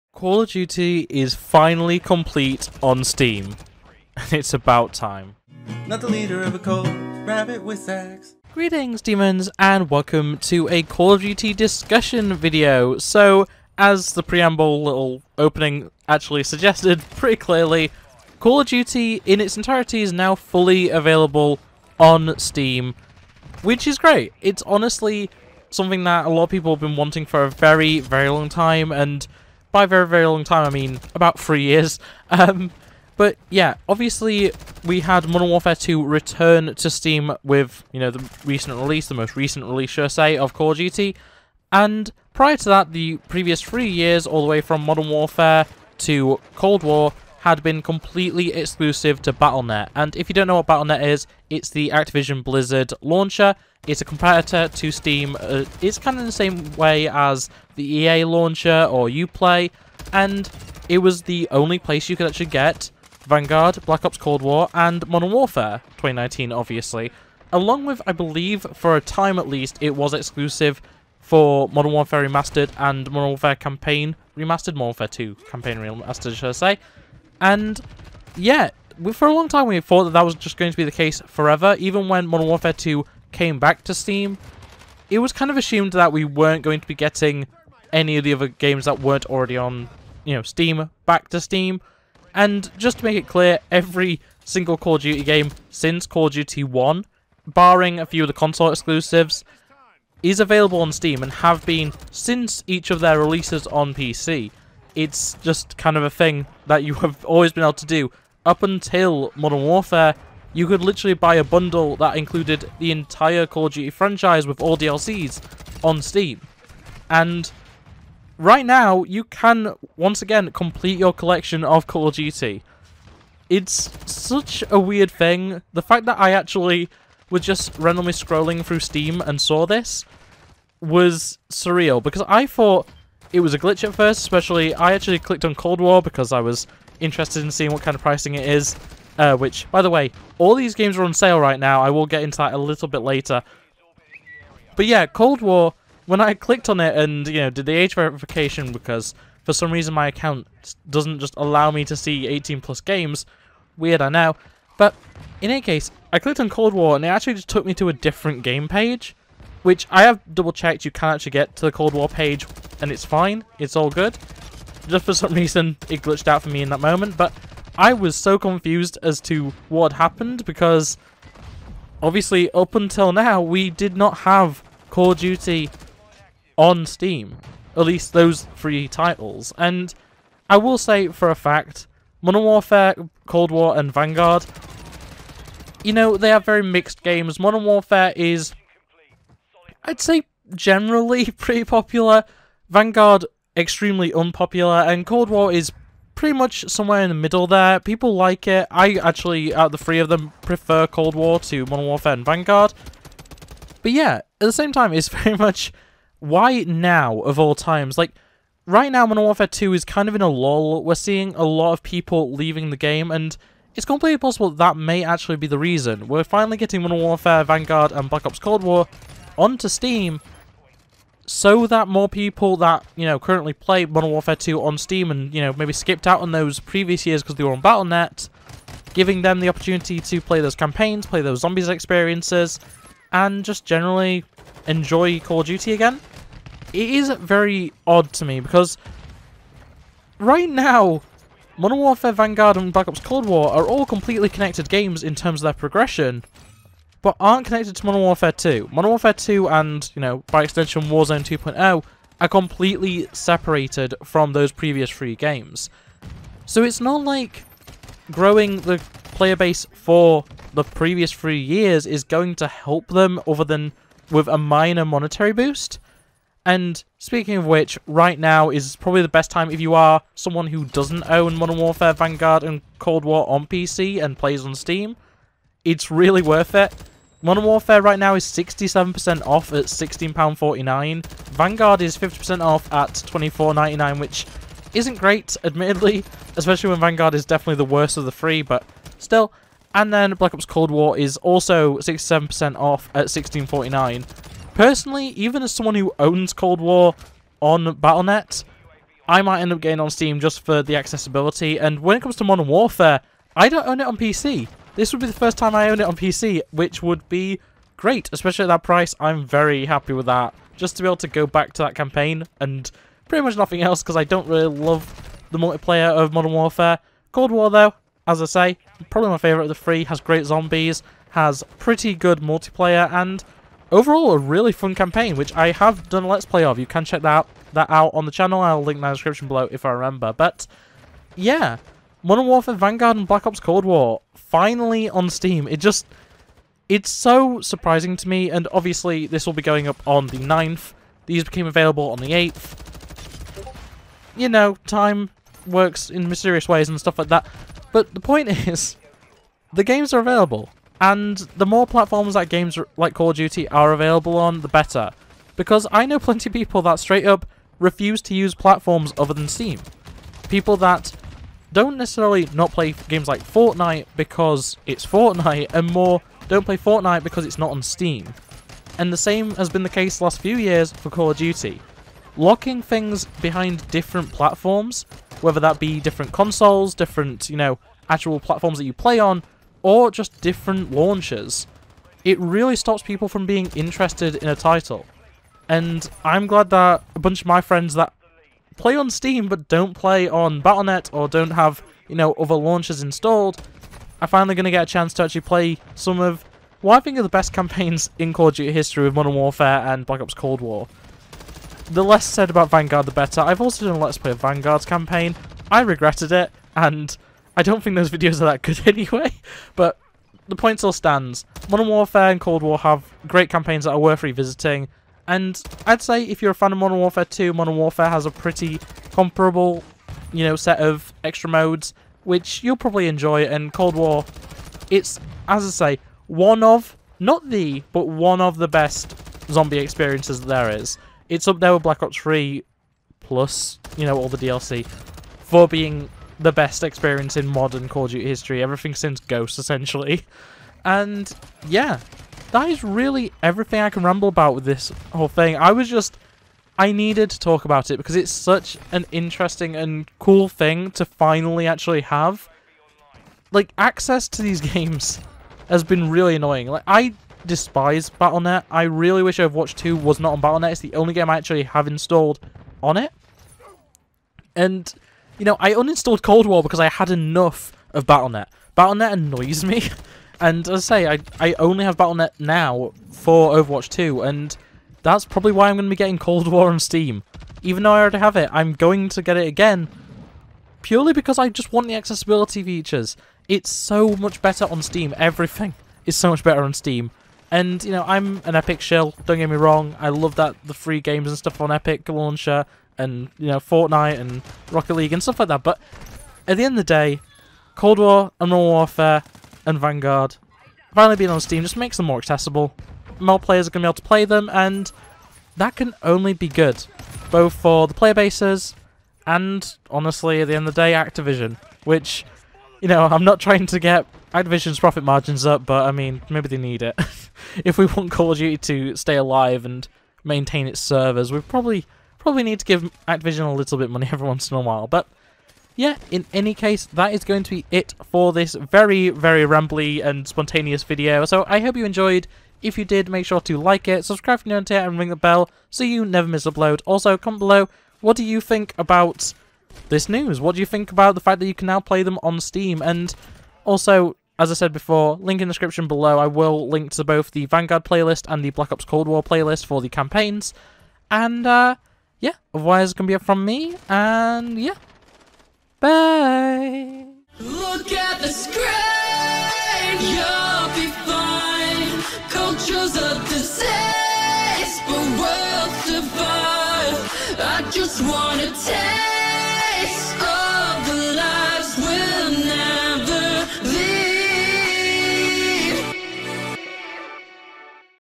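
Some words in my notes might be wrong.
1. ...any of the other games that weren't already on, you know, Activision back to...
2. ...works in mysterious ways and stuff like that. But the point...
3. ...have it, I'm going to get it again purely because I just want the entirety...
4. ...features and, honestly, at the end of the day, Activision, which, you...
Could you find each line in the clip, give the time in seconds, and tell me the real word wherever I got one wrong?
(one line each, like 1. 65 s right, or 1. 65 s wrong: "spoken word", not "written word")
1. 87 s wrong: "Steam", not "Activision"
2. 345 s right
3. 477 s wrong: "accessibility", not "entirety"
4. 507 s wrong: "bases", not "features".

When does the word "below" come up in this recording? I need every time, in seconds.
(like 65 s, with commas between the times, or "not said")
329 s, 537 s, 545 s.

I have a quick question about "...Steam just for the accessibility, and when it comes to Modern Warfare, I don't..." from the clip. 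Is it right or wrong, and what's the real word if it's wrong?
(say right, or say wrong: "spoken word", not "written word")
right.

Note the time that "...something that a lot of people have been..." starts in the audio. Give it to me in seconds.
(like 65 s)
25 s.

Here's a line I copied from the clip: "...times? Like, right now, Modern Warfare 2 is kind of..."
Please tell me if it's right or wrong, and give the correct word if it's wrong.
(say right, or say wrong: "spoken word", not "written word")
right.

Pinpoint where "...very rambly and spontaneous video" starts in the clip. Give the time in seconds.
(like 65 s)
528 s.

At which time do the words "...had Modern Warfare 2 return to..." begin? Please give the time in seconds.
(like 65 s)
35 s.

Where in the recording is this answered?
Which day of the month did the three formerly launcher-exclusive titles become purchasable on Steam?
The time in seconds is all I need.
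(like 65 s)
341 s.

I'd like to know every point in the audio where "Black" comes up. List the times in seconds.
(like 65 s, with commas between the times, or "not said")
63 s, 218 s, 242 s, 290 s, 333 s, 399 s, 431 s, 548 s.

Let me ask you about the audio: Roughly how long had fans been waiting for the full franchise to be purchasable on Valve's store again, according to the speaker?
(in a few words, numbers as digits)
about three years.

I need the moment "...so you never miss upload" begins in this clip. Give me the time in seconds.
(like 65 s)
535 s.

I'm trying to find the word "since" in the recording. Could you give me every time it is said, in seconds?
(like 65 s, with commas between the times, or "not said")
95 s, 102 s, 438 s.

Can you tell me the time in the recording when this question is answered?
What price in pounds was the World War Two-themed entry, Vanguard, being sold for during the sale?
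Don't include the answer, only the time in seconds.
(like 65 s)
283 s.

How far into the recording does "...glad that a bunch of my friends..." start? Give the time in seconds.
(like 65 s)
386 s.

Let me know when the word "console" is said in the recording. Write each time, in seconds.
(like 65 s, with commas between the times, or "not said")
98 s, 376 s.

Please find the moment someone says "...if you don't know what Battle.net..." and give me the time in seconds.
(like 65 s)
50 s.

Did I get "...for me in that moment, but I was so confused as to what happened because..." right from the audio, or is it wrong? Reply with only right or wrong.
right.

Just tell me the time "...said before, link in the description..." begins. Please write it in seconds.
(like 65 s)
544 s.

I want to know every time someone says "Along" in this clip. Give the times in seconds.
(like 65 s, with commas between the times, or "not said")
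67 s.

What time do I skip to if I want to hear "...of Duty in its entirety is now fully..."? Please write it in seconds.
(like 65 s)
18 s.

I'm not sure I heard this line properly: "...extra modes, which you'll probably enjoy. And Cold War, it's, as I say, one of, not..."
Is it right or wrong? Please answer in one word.
right.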